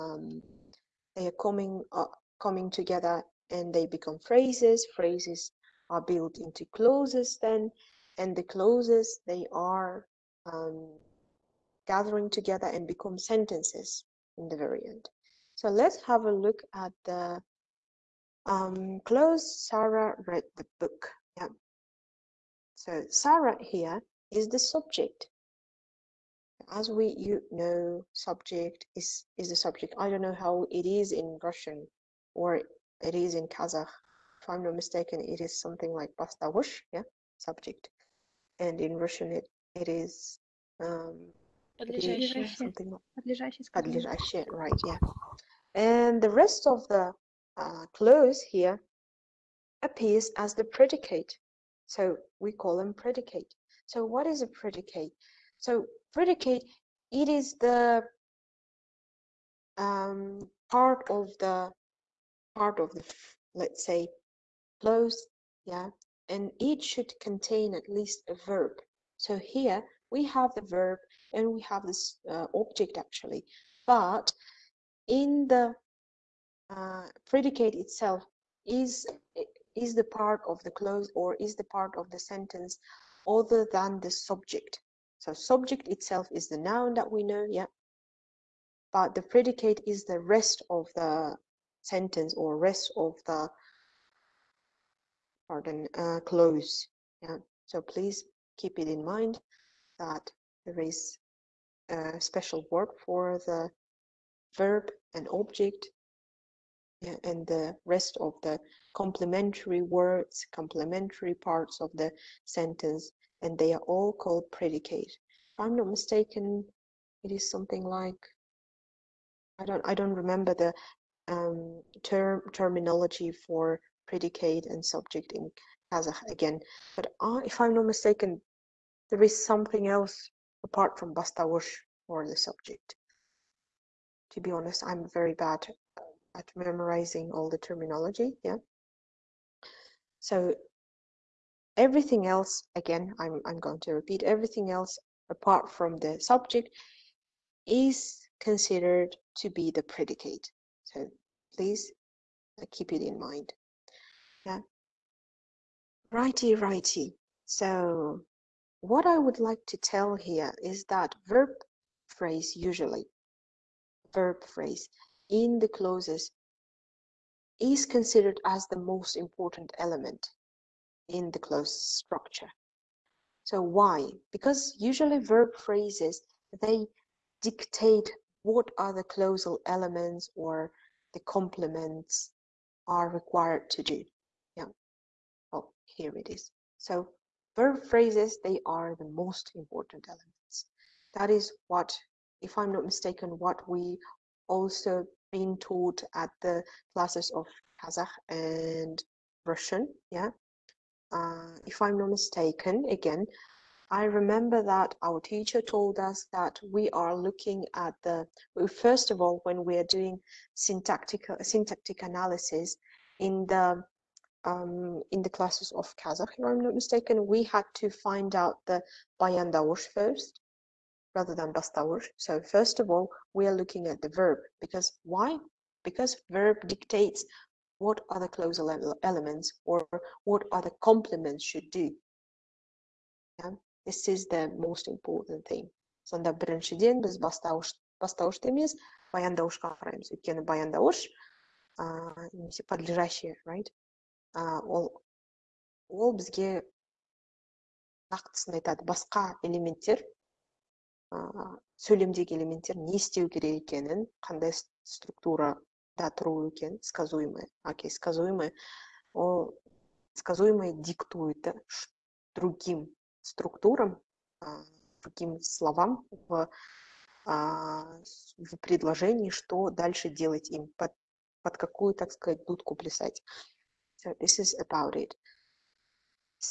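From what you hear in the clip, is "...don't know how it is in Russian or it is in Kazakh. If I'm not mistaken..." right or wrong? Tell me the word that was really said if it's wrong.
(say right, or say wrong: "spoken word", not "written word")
right.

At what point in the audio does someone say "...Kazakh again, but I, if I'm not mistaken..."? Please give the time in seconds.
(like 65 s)
125 s.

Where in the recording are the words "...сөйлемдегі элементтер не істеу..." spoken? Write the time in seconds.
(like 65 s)
251 s.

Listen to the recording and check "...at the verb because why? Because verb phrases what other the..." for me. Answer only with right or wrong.
wrong.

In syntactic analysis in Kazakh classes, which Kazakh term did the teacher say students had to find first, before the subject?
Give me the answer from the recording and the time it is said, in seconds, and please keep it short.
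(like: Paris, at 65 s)
bayandawash, at 219 s.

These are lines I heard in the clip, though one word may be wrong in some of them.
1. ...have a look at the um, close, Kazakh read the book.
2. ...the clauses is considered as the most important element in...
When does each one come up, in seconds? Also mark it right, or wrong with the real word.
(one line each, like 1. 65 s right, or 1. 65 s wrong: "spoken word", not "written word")
1. 16 s wrong: "Sarah", not "Kazakh"
2. 165 s right.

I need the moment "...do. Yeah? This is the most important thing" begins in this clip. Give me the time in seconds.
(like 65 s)
231 s.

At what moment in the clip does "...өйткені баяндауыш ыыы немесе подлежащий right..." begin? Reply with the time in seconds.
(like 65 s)
240 s.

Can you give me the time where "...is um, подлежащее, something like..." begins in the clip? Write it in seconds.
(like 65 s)
39 s.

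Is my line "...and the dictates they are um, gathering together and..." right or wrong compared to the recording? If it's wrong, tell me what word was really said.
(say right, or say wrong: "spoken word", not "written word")
wrong: "clauses", not "dictates".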